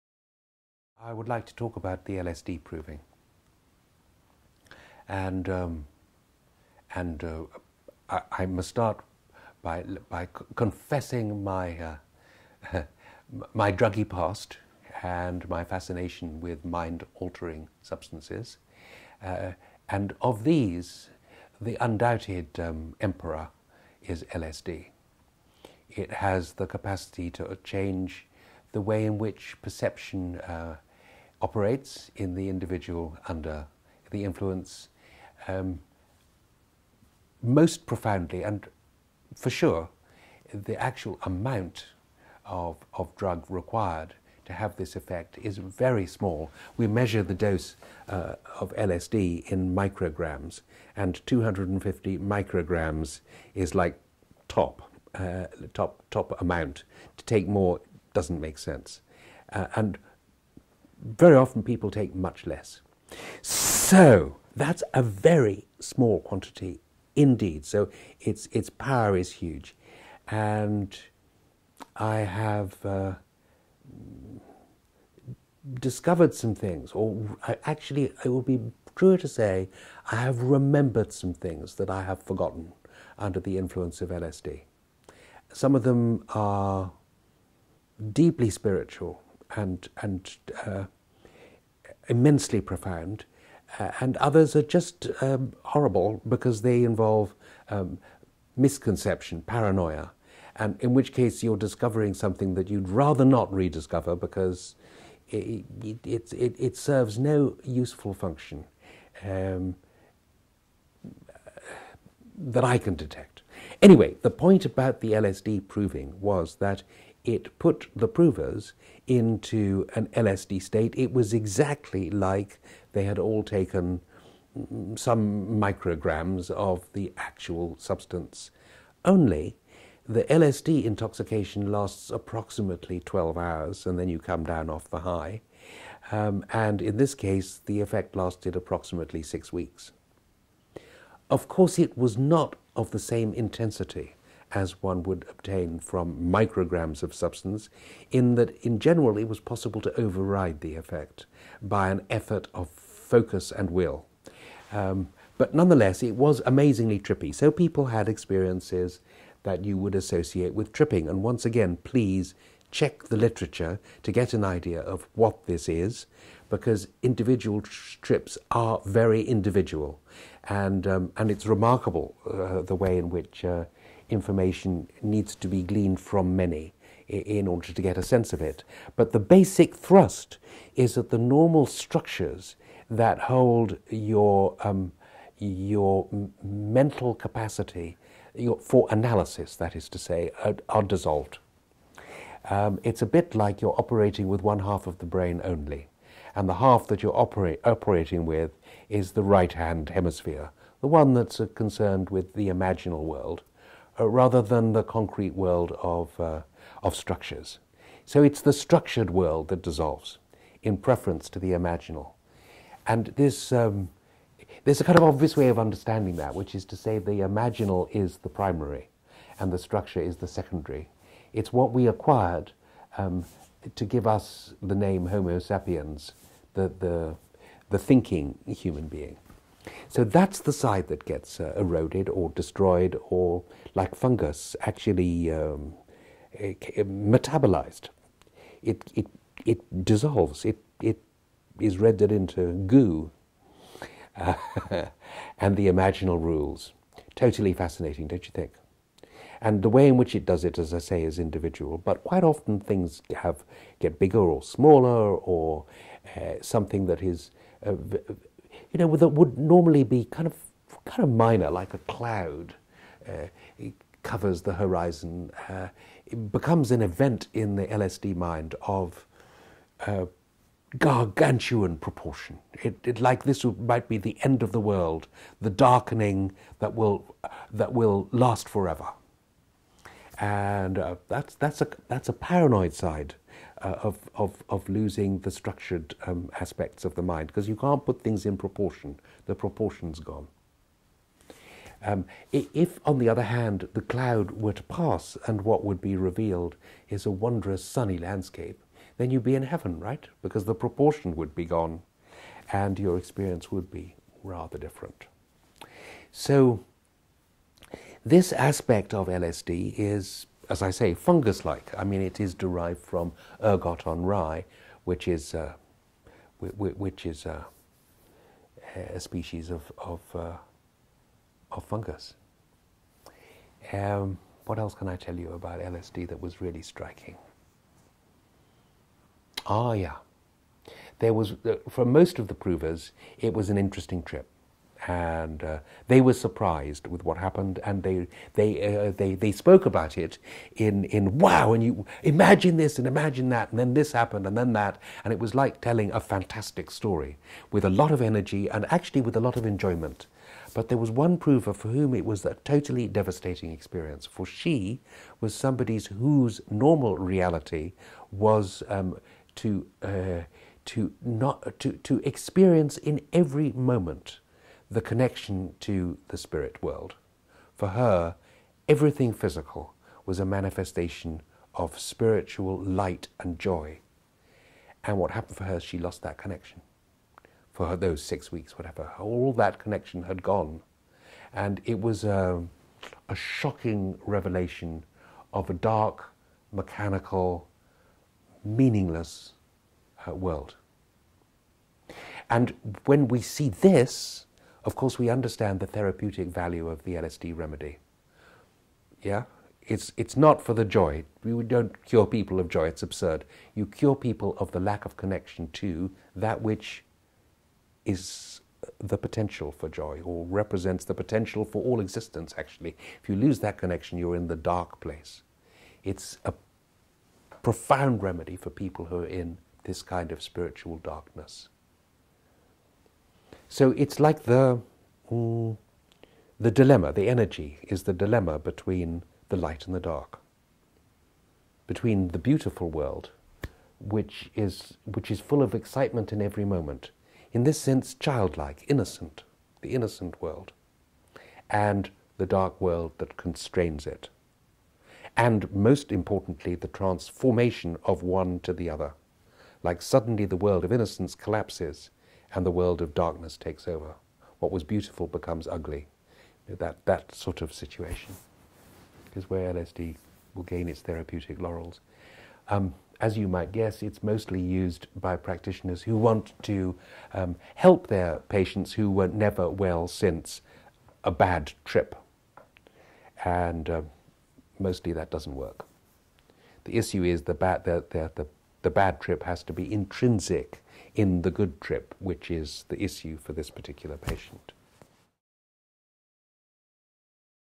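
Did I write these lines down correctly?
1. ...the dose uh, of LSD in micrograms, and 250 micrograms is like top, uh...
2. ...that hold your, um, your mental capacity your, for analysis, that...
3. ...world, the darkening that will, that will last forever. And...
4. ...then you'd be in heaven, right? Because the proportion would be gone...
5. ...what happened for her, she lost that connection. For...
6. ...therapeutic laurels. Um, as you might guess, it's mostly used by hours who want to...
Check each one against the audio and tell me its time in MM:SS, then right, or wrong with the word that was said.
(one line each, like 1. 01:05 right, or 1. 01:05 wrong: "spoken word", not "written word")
1. 00:47 right
2. 03:02 right
3. 04:34 right
4. 04:58 right
5. 06:14 right
6. 07:40 wrong: "practitioners", not "hours".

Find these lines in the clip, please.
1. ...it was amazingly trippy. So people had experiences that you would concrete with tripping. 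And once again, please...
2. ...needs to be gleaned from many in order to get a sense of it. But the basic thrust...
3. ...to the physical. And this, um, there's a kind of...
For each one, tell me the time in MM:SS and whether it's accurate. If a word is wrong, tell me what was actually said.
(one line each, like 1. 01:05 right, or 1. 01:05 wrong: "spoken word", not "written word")
1. 02:36 wrong: "associate", not "concrete"
2. 02:55 right
3. 03:31 wrong: "imaginal", not "physical".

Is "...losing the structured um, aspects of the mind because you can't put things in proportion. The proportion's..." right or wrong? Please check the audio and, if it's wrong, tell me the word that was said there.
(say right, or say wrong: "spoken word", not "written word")
right.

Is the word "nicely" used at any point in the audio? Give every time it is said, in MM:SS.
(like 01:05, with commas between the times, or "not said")
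not said.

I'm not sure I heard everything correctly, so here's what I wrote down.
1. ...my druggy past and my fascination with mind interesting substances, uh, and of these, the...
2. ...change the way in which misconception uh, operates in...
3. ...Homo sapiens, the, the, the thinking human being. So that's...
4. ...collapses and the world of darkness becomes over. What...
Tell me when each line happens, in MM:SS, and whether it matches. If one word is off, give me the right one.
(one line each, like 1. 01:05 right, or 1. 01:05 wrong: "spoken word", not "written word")
1. 00:13 wrong: "altering", not "interesting"
2. 00:27 wrong: "perception", not "misconception"
3. 03:45 right
4. 07:31 wrong: "takes", not "becomes".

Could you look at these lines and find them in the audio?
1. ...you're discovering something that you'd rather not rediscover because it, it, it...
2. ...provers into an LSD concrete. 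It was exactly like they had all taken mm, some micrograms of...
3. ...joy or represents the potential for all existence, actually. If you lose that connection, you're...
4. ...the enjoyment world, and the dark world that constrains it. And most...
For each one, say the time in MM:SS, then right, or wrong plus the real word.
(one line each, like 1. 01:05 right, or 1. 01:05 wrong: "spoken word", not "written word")
1. 01:41 right
2. 01:58 wrong: "state", not "concrete"
3. 06:49 right
4. 07:19 wrong: "innocent", not "enjoyment".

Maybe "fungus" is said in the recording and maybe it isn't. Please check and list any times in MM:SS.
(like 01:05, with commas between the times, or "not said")
03:53, 05:10, 05:21.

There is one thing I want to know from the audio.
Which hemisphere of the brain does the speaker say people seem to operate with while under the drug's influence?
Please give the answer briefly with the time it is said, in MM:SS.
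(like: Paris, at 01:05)
Right hand hemisphere, at 03:19.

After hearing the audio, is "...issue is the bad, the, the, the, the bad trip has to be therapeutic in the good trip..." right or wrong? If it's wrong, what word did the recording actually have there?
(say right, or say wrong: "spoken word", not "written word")
wrong: "intrinsic", not "therapeutic".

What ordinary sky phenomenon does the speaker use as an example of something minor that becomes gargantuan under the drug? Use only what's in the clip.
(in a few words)
A cloud.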